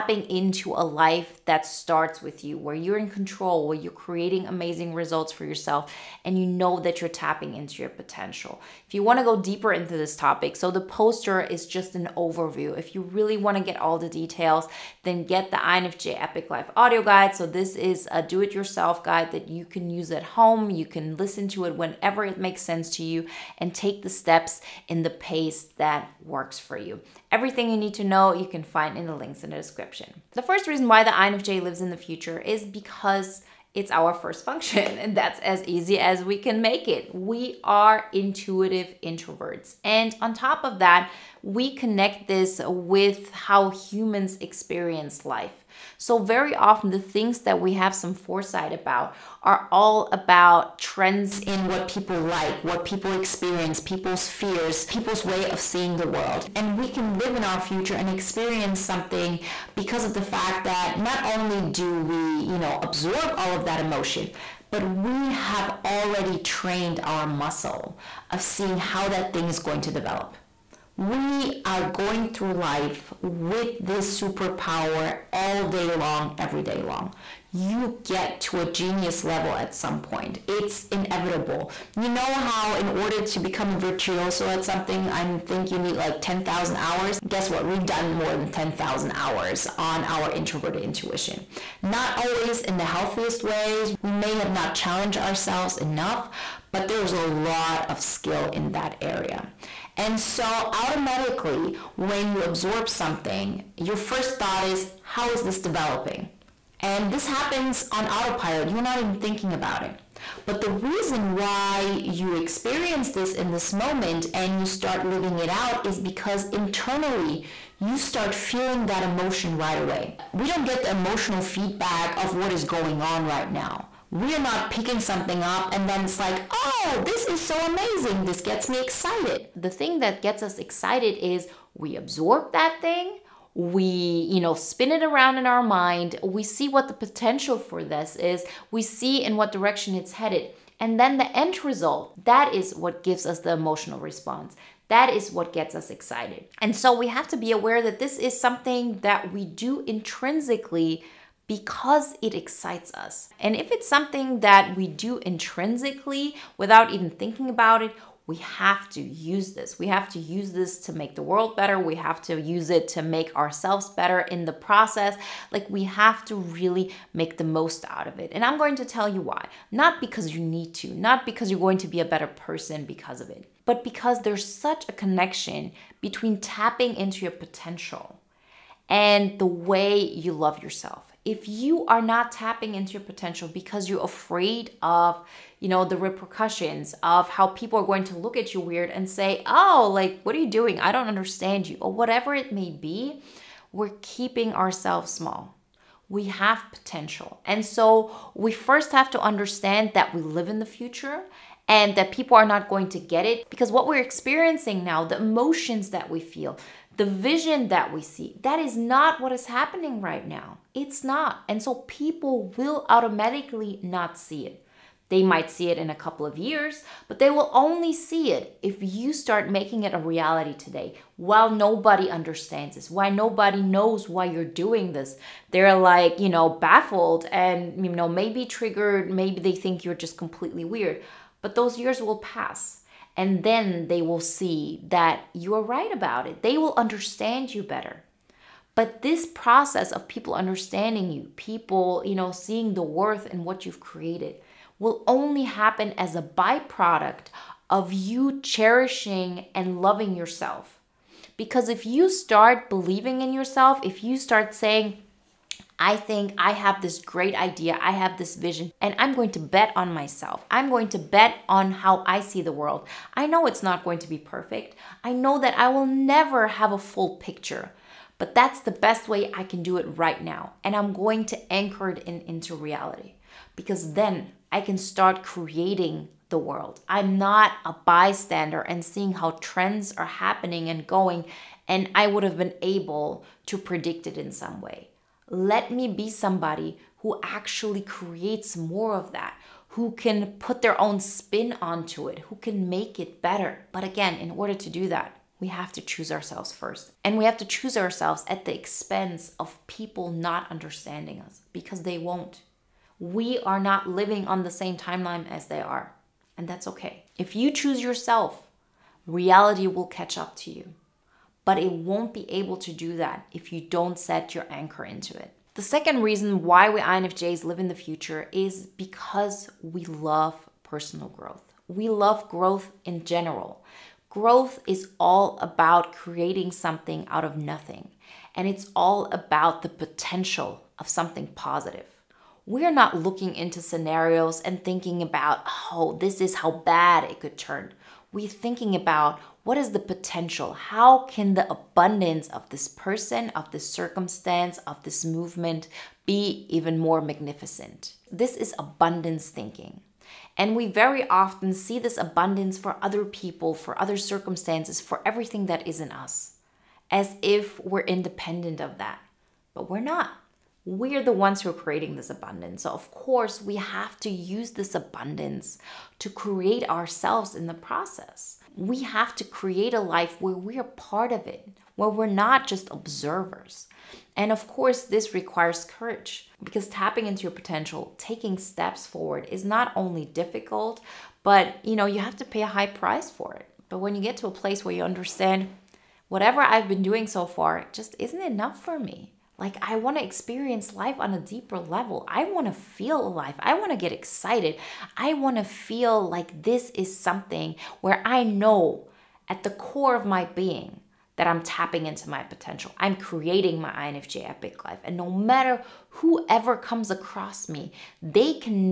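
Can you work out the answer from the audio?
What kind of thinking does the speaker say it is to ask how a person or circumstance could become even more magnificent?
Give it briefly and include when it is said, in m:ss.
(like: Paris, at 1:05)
Abundance thinking, at 5:48.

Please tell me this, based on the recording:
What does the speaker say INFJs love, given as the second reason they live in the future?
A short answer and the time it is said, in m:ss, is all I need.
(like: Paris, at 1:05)
Personal growth, at 5:20.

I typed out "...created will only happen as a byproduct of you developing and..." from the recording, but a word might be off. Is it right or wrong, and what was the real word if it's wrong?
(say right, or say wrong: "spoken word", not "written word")
wrong: "cherishing", not "developing".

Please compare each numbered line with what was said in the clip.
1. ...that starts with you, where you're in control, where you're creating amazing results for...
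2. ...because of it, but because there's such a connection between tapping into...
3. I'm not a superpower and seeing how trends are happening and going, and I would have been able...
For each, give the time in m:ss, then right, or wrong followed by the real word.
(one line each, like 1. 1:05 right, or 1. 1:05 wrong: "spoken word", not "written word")
1. 0:01 right
2. 2:52 right
3. 4:36 wrong: "bystander", not "superpower".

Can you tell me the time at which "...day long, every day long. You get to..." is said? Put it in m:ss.
1:15.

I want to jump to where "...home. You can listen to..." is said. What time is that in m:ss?
0:20.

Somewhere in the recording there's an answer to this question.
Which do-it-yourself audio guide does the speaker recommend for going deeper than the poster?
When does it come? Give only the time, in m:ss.
0:15.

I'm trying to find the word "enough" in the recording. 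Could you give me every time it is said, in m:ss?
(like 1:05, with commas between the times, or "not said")
1:35, 6:28.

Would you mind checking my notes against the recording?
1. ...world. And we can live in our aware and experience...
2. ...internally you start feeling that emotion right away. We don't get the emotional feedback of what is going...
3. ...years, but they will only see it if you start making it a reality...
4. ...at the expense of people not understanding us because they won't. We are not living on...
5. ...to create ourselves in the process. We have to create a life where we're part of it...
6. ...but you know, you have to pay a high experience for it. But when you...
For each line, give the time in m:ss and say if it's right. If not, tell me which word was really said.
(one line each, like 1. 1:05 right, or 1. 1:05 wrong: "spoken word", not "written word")
1. 0:56 wrong: "future", not "aware"
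2. 1:56 right
3. 3:36 right
4. 4:58 right
5. 6:05 right
6. 6:21 wrong: "price", not "experience".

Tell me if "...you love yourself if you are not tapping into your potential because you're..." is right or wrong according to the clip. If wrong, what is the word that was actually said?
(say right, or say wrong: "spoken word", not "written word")
right.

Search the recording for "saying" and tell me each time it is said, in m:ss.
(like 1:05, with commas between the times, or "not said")
4:14.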